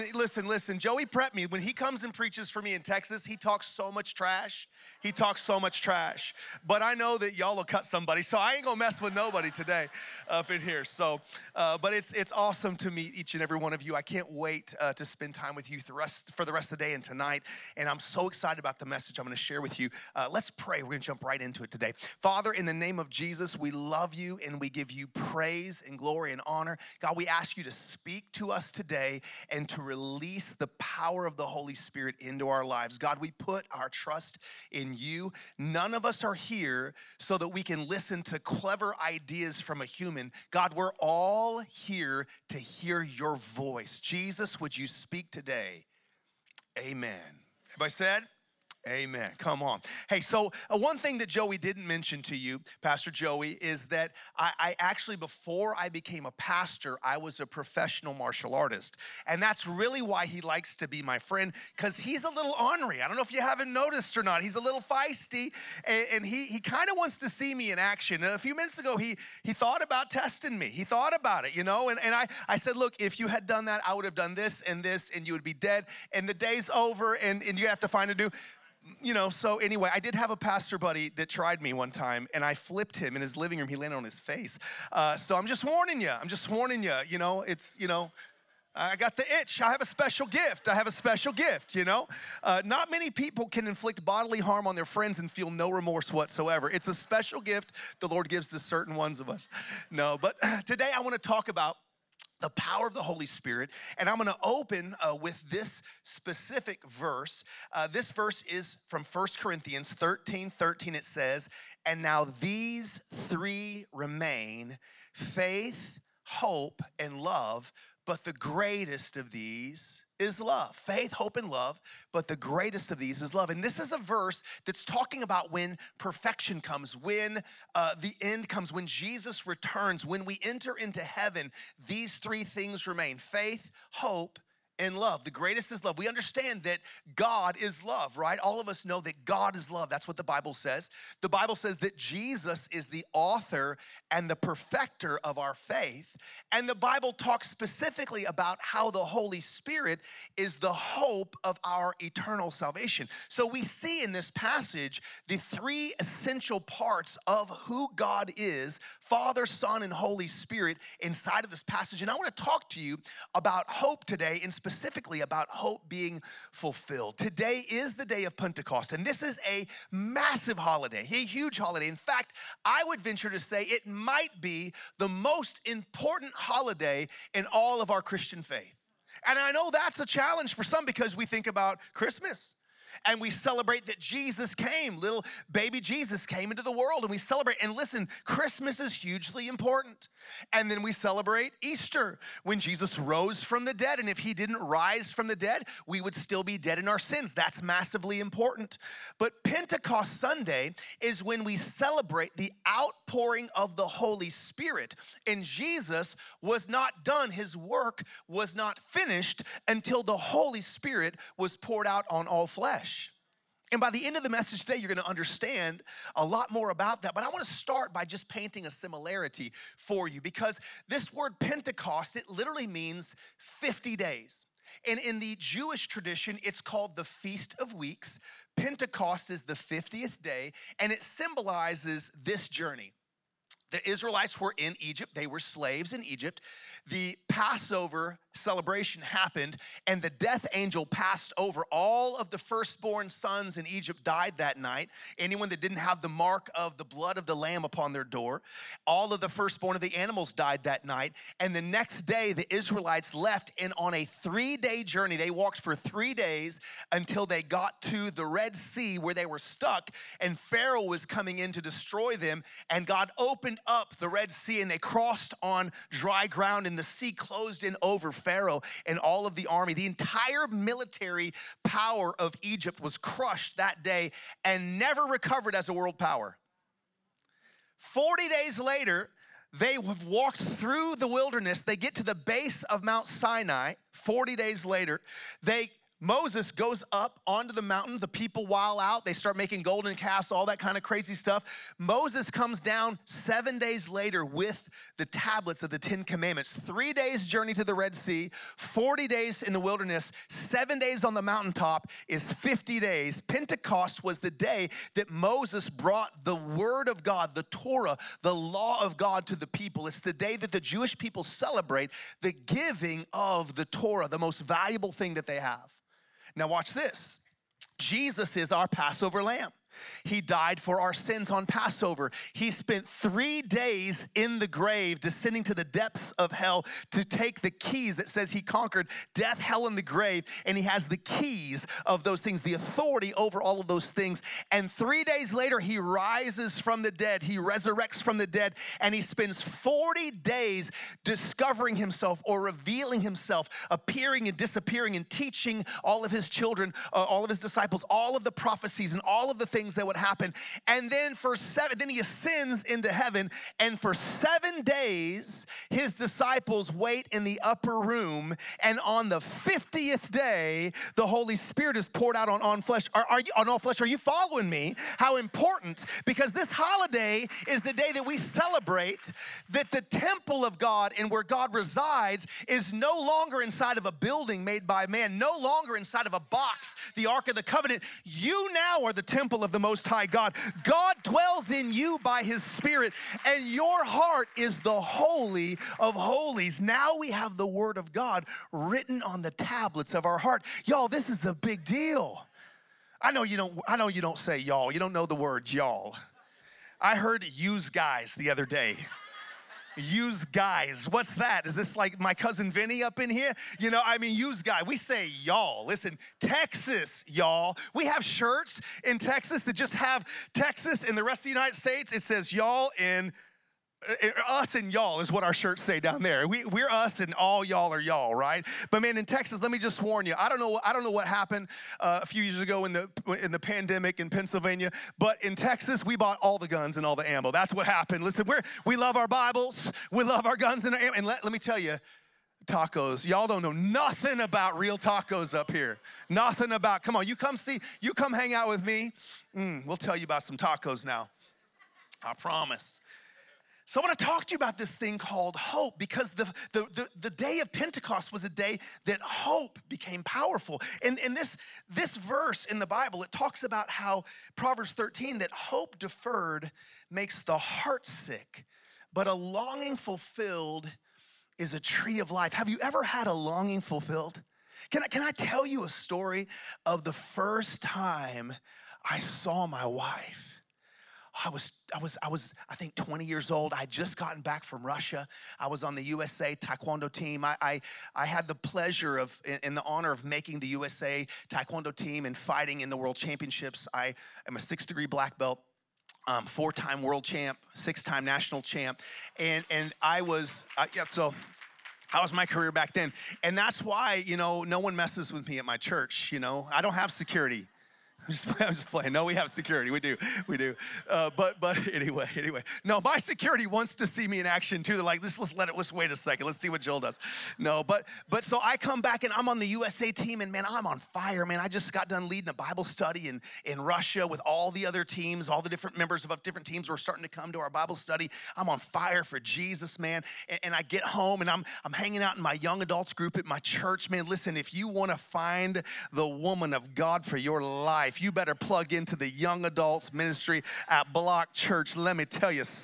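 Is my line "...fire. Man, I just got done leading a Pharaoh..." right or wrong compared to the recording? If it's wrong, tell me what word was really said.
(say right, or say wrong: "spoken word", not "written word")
wrong: "Bible", not "Pharaoh".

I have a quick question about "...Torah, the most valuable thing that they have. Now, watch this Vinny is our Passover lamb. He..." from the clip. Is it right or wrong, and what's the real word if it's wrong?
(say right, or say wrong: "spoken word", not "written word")
wrong: "Jesus", not "Vinny".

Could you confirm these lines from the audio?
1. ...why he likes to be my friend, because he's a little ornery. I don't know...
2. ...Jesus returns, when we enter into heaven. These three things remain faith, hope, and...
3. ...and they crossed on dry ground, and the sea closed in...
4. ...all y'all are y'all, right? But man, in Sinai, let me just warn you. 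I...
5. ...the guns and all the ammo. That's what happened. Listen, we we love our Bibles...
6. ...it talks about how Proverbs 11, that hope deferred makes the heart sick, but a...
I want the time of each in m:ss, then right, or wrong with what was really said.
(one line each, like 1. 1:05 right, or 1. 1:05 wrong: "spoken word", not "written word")
1. 1:00 right
2. 2:08 right
3. 4:24 right
4. 6:57 wrong: "Texas", not "Sinai"
5. 7:06 right
6. 7:33 wrong: "13", not "11".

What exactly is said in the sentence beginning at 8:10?
So how was my career back then, and that's why you know no one messes with me at my church.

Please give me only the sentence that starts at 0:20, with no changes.
We're gonna jump right into it today.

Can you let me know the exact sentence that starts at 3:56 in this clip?
The Passover celebration happened, and the death angel passed over.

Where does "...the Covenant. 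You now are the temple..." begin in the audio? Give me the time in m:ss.
6:17.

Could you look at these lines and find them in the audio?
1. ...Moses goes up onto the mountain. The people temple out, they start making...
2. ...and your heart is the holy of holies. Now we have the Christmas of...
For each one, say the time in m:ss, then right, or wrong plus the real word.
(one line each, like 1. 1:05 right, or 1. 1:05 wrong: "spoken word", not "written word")
1. 4:46 wrong: "while", not "temple"
2. 6:23 wrong: "Word", not "Christmas".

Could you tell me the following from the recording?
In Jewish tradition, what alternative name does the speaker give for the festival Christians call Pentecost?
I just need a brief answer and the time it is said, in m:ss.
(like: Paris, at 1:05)
Feast of Weeks, at 3:47.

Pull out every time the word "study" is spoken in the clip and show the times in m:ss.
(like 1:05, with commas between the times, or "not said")
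8:32, 8:37.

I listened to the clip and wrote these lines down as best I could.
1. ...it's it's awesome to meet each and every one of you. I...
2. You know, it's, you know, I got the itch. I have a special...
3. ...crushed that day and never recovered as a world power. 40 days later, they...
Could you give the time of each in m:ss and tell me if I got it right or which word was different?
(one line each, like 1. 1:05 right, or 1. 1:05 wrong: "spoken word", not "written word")
1. 0:11 right
2. 1:27 right
3. 4:32 right.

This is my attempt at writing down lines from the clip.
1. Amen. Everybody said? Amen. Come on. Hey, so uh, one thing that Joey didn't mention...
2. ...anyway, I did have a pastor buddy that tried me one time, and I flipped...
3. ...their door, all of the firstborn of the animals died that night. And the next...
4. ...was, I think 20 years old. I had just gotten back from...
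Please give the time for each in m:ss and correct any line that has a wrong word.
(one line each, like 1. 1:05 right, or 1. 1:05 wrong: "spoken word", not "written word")
1. 0:46 right
2. 1:19 right
3. 4:07 right
4. 7:52 right.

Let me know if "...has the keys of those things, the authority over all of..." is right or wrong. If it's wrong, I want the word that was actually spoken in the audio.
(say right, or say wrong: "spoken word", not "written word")
right.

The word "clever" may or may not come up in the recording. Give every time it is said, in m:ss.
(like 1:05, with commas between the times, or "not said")
0:38.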